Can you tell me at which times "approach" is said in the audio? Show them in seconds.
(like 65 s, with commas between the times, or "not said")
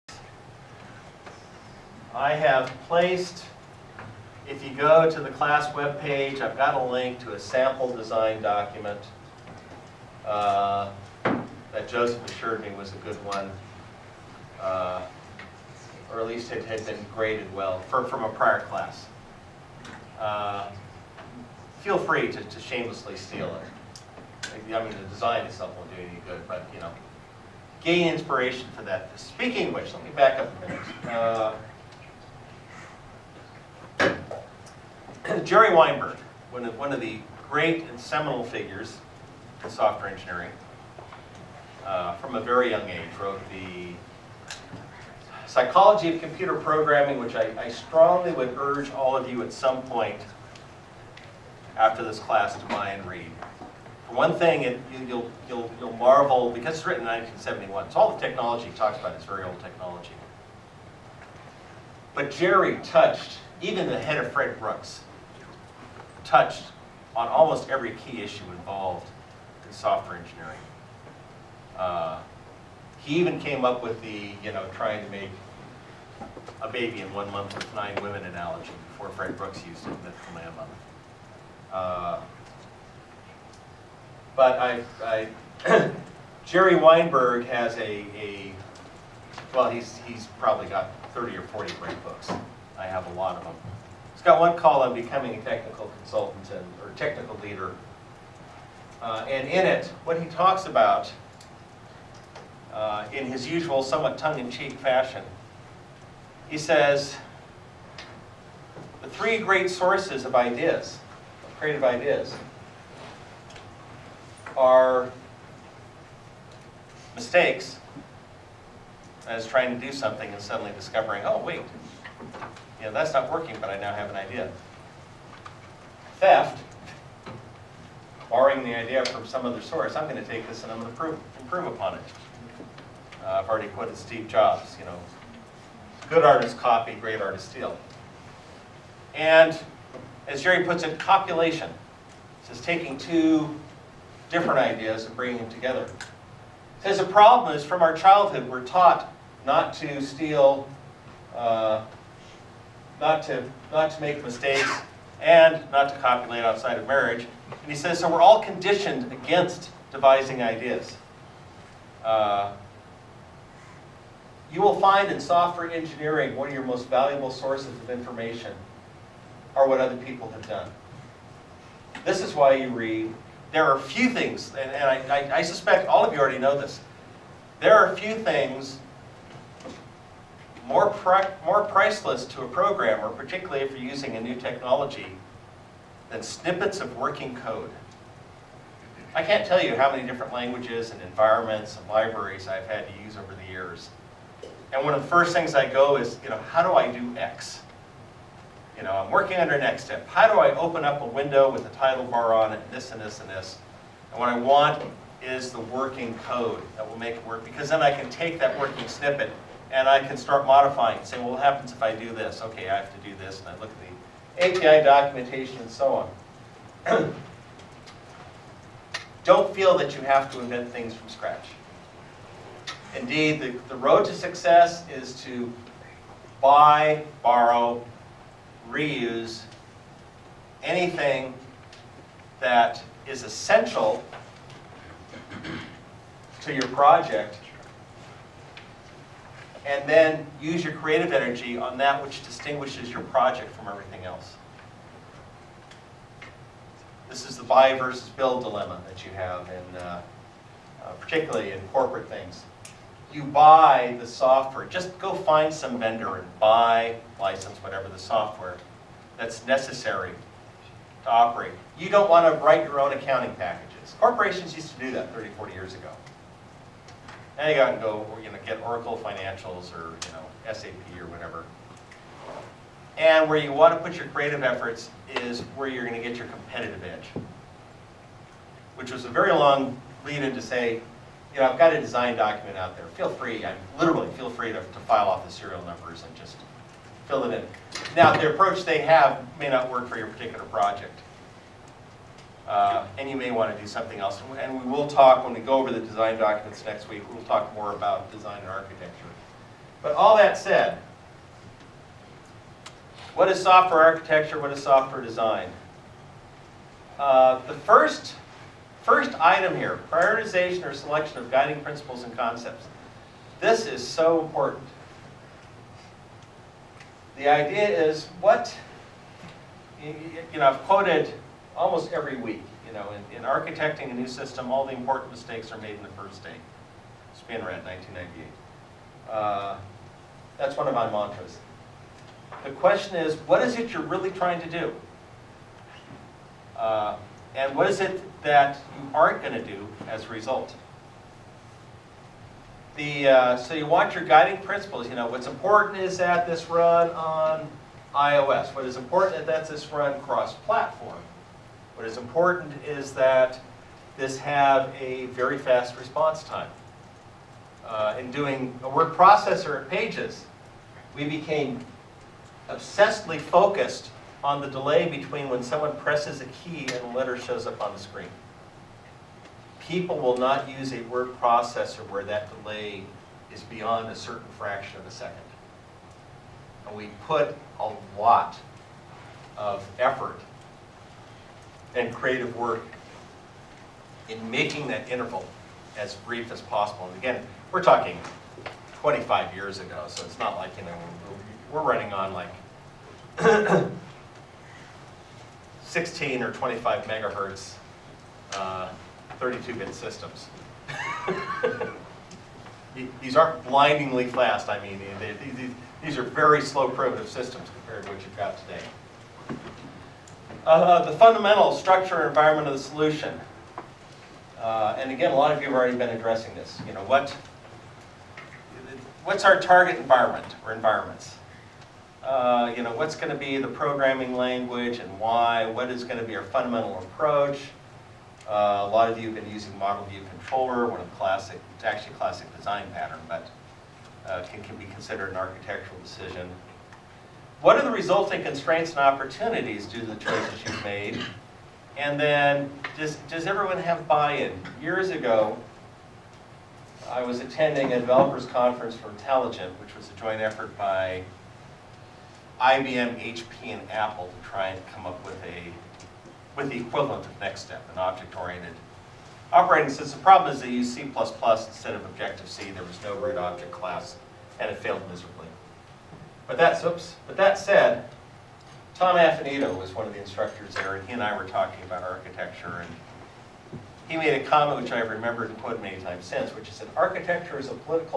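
288 s, 426 s.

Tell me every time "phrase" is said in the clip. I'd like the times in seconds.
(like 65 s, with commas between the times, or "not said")
not said.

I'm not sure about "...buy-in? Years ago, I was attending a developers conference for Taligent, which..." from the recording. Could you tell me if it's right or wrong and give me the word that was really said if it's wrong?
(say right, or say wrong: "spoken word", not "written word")
right.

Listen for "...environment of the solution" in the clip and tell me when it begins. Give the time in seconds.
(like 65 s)
412 s.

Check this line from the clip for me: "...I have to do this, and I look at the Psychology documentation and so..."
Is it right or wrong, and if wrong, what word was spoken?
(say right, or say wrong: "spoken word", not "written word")
wrong: "API", not "Psychology".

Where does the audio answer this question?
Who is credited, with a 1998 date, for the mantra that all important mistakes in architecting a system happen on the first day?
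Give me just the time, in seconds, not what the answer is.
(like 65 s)
327 s.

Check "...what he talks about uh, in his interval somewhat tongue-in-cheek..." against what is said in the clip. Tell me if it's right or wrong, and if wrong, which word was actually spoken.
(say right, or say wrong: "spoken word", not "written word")
wrong: "usual", not "interval".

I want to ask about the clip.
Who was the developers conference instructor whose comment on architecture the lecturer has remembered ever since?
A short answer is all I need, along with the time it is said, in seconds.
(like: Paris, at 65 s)
Tom Affinito, at 468 s.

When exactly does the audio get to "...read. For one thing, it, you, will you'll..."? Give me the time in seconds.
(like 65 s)
53 s.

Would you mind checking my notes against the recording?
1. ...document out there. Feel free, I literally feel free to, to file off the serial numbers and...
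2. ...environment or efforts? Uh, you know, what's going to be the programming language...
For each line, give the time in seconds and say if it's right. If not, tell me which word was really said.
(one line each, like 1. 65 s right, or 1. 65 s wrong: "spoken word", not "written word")
1. 282 s right
2. 419 s wrong: "environments", not "efforts".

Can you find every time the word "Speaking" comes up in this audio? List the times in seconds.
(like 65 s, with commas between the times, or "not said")
29 s.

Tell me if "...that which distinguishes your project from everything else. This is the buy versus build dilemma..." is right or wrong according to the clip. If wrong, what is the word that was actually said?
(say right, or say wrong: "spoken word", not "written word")
right.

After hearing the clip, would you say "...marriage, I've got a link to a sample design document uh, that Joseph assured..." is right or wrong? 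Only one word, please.
wrong.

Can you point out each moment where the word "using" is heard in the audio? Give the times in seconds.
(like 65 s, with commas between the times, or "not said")
183 s, 429 s.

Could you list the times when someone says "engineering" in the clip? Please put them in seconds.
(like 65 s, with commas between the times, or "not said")
40 s, 70 s, 165 s.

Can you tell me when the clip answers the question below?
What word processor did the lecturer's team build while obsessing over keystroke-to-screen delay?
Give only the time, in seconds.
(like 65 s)
359 s.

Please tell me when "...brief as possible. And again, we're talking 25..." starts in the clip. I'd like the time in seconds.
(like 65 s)
385 s.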